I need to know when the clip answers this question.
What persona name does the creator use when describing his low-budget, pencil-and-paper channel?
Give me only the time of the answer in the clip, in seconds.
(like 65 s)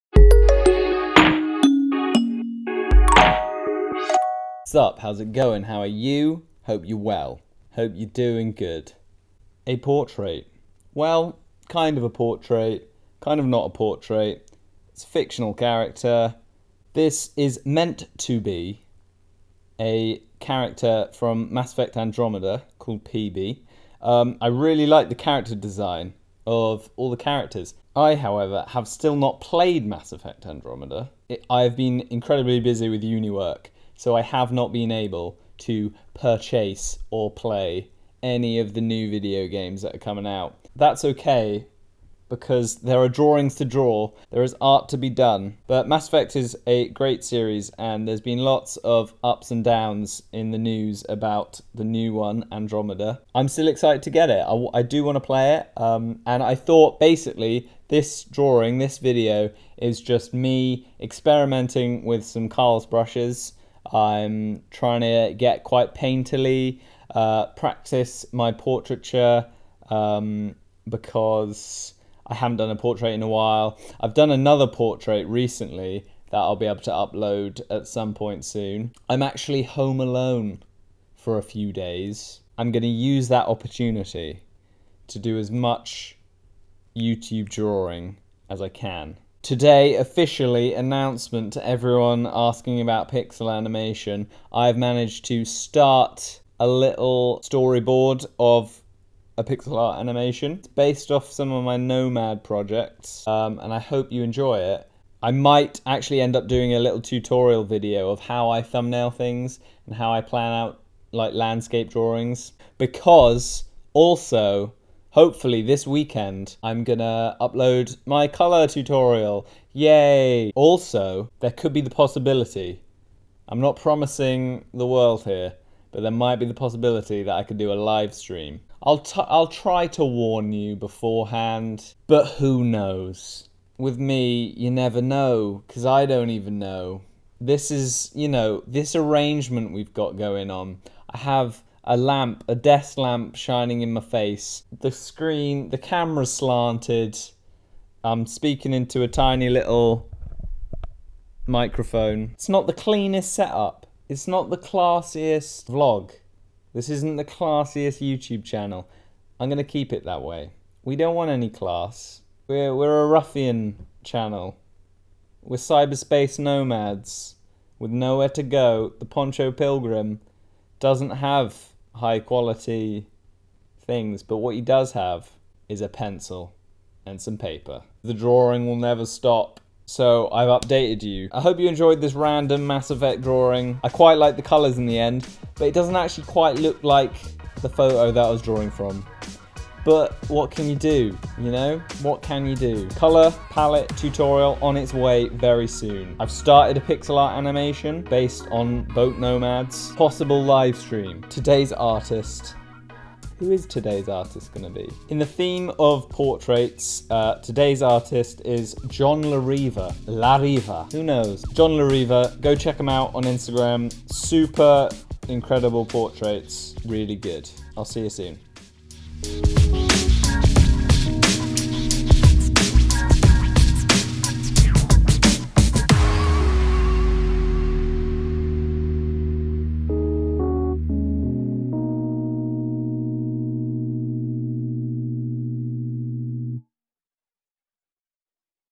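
168 s.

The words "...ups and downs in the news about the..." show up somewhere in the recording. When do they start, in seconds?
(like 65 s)
49 s.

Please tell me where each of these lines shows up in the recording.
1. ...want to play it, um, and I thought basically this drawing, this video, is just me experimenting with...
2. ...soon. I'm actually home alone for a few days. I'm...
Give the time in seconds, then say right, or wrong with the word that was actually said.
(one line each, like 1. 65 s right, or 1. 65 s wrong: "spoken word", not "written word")
1. 55 s right
2. 78 s right.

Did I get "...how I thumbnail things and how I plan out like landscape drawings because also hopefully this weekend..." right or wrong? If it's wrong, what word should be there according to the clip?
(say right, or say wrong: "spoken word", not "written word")
right.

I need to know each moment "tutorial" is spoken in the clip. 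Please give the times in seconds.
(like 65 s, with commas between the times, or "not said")
107 s, 118 s, 193 s.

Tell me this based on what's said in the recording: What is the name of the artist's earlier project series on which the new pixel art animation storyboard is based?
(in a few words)
Nomad.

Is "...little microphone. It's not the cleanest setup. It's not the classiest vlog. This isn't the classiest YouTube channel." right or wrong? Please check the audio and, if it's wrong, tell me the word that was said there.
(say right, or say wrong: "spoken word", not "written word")
right.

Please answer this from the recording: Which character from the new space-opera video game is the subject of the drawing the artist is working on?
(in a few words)
PeeBee.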